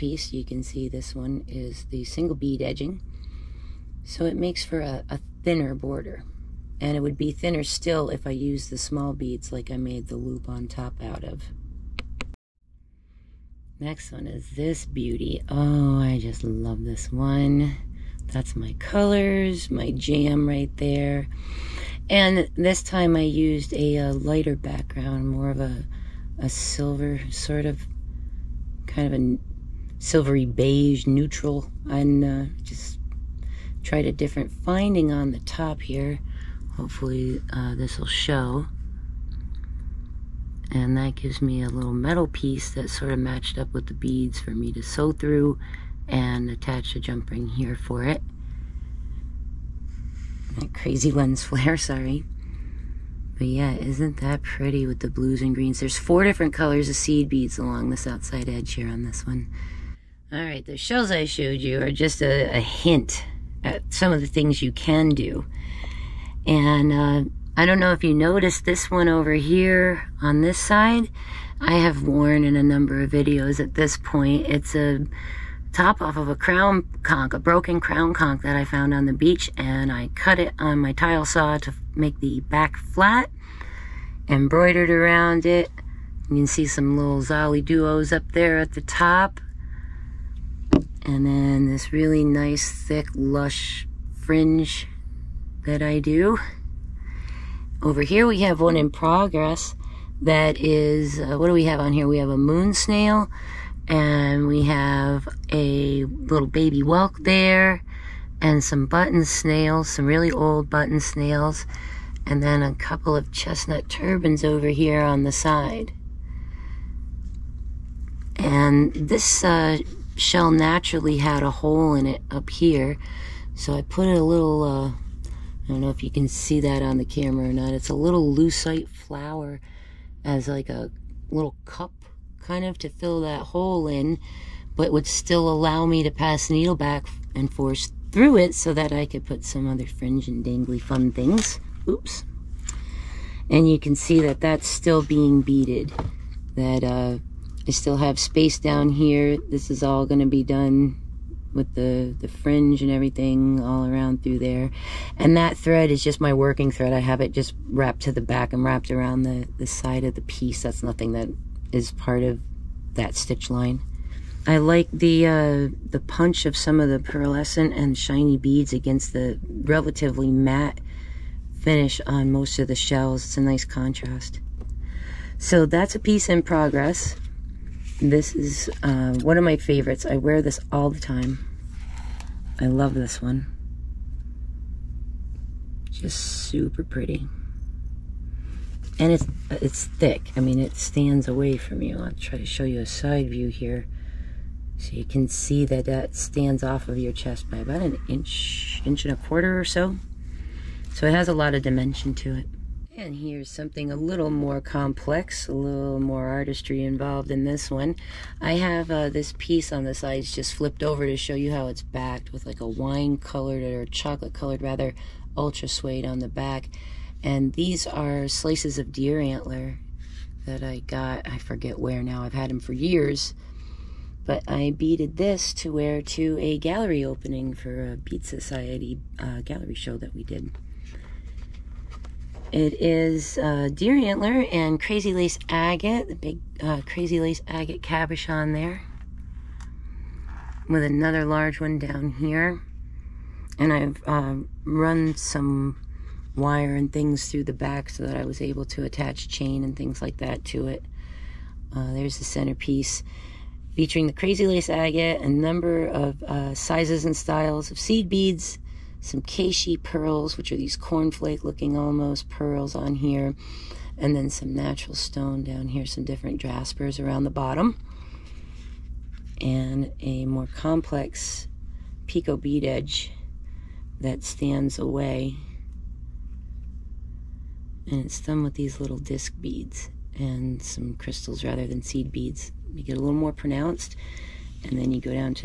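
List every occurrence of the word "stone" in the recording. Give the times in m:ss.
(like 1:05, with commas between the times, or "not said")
4:24.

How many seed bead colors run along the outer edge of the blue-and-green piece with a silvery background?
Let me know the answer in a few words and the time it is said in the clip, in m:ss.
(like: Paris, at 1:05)
4, at 0:55.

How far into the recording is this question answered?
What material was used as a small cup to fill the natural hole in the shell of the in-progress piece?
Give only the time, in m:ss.
2:08.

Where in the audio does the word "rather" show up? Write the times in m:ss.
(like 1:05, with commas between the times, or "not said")
3:34, 4:41.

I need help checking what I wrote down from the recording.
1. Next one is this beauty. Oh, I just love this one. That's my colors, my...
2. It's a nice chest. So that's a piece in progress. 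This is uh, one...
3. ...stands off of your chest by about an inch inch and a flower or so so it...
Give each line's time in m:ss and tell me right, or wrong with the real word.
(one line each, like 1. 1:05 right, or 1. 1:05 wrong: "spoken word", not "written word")
1. 0:13 right
2. 2:53 wrong: "contrast", not "chest"
3. 3:16 wrong: "quarter", not "flower".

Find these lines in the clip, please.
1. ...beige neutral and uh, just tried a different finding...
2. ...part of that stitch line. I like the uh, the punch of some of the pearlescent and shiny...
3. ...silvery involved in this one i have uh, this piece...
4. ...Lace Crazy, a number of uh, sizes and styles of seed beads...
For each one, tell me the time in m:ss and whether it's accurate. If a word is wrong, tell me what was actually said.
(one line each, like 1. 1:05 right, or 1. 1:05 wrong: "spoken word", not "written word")
1. 0:30 right
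2. 2:41 right
3. 3:26 wrong: "artistry", not "silvery"
4. 4:14 wrong: "Agate", not "Crazy".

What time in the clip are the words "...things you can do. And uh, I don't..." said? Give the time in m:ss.
1:04.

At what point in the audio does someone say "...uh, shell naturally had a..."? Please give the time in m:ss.
1:59.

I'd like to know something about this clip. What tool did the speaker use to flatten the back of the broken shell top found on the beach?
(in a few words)
tile saw.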